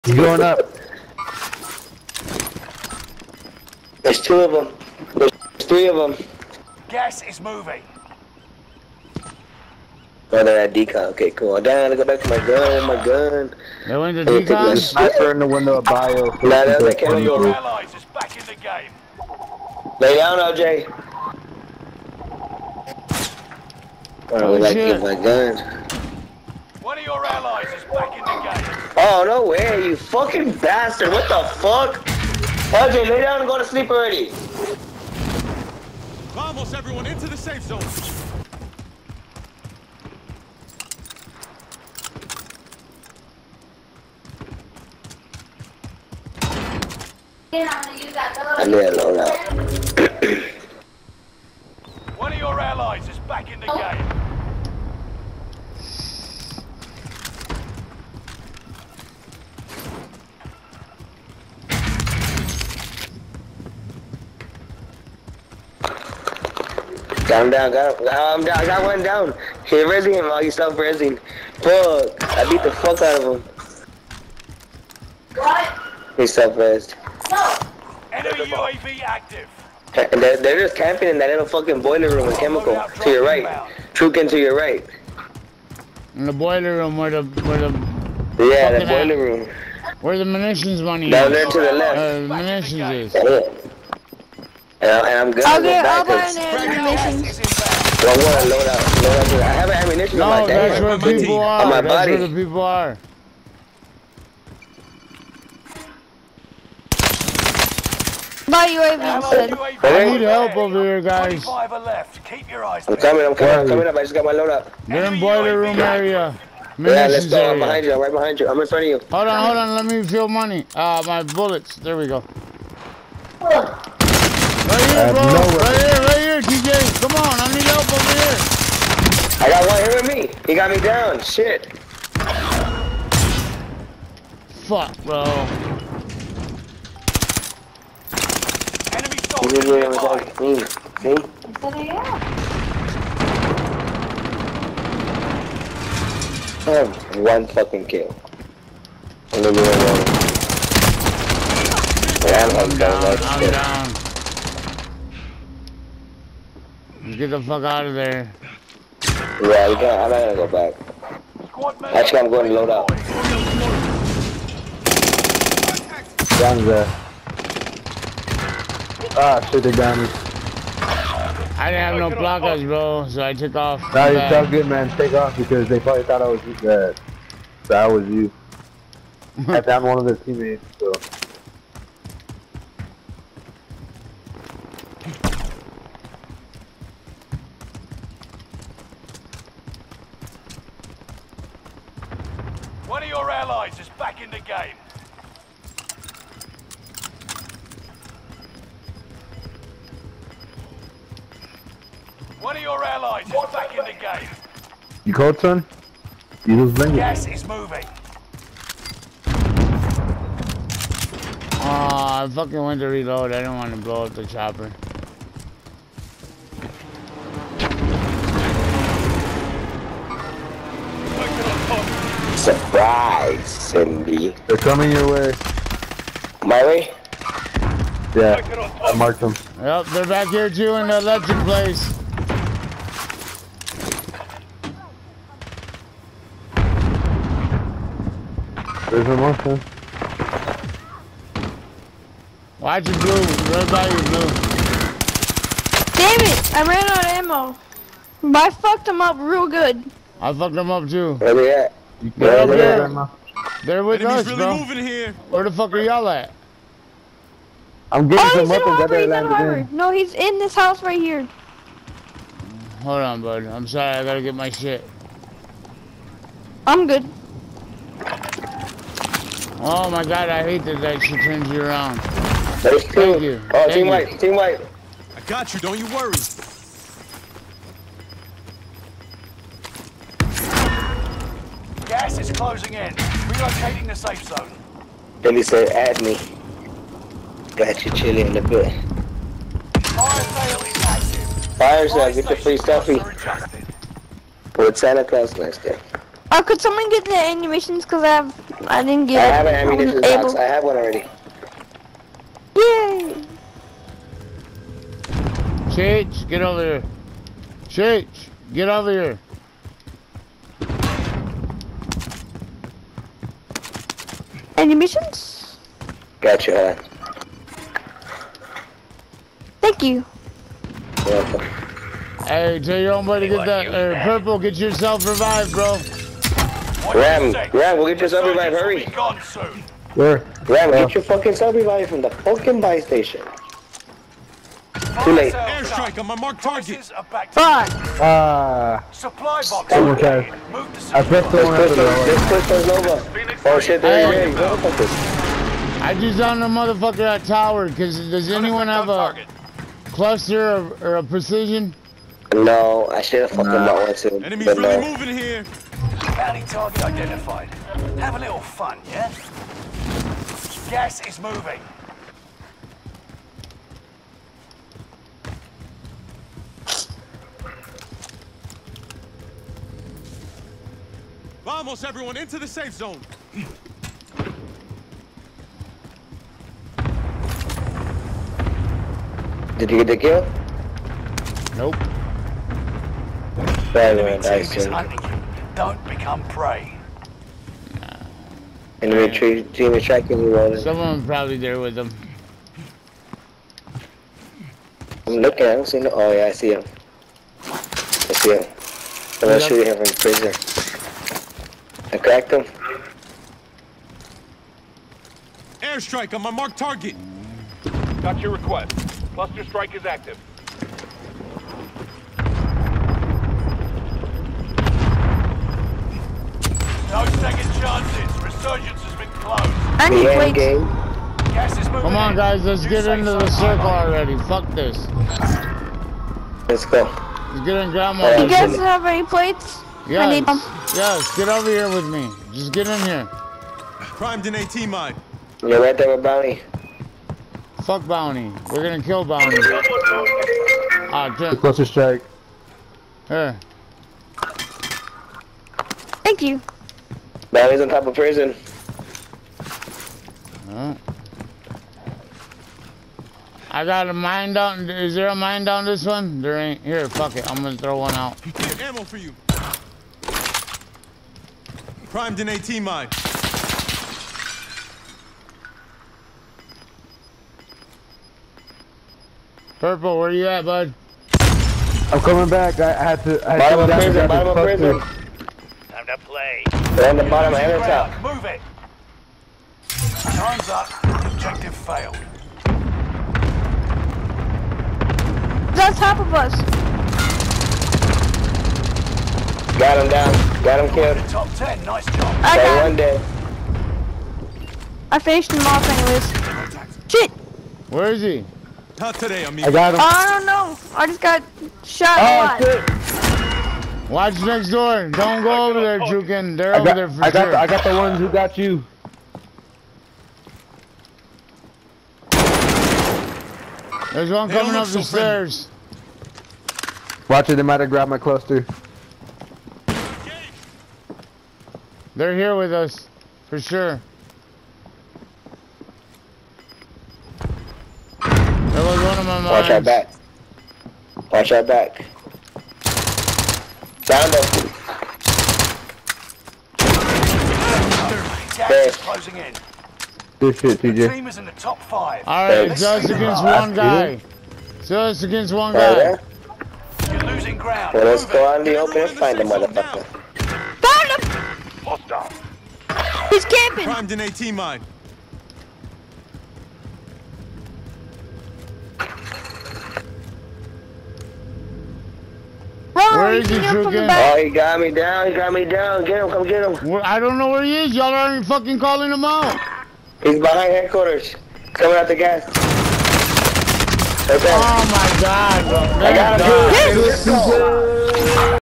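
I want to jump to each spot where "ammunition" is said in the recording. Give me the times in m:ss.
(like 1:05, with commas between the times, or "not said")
1:39, 4:59.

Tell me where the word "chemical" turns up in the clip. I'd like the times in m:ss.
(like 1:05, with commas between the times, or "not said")
1:22.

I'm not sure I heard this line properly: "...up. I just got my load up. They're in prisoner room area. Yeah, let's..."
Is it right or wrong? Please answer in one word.
wrong.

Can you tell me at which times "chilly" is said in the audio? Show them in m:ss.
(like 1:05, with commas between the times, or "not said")
4:47.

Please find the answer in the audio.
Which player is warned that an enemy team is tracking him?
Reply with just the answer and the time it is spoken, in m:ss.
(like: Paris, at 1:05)
Ronan, at 6:30.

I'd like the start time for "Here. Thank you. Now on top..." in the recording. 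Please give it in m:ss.
7:23.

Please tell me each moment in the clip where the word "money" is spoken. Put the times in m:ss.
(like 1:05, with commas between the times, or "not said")
1:30, 2:00.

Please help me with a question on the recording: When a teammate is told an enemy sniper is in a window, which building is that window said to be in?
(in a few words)
Bio.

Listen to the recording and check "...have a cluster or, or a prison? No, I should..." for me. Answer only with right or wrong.
wrong.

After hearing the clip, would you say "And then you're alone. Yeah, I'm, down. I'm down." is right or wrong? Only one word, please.
right.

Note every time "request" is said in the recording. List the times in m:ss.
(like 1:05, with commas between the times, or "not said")
6:48.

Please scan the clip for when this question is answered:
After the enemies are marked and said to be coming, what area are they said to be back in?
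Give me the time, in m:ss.
3:50.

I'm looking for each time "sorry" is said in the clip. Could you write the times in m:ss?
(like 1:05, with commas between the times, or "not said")
4:23.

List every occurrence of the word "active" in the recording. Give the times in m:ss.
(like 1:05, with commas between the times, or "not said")
1:19, 6:49.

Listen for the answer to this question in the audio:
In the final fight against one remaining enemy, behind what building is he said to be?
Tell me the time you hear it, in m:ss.
9:30.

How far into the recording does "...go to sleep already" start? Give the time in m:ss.
0:33.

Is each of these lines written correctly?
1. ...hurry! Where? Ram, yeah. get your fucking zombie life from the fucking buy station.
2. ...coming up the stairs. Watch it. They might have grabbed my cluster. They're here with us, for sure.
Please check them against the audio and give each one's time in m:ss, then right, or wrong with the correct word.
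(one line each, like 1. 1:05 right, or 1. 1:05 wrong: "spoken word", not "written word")
1. 5:28 right
2. 8:34 right.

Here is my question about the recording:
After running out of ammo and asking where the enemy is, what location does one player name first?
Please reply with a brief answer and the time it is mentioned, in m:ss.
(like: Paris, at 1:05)
Harbor, at 4:19.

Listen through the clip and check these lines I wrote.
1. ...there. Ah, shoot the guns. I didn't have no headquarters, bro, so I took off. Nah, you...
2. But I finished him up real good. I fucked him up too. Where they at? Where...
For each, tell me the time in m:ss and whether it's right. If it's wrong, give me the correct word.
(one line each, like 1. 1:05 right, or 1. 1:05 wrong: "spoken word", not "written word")
1. 2:46 wrong: "blockers", not "headquarters"
2. 4:08 wrong: "fucked", not "finished".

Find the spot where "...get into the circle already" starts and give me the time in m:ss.
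7:02.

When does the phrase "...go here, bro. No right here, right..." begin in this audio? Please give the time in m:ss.
2:02.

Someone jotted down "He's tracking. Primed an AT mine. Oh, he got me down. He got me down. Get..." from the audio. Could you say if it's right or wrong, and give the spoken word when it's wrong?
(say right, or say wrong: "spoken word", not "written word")
wrong: "camping", not "tracking".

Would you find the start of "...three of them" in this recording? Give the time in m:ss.
0:05.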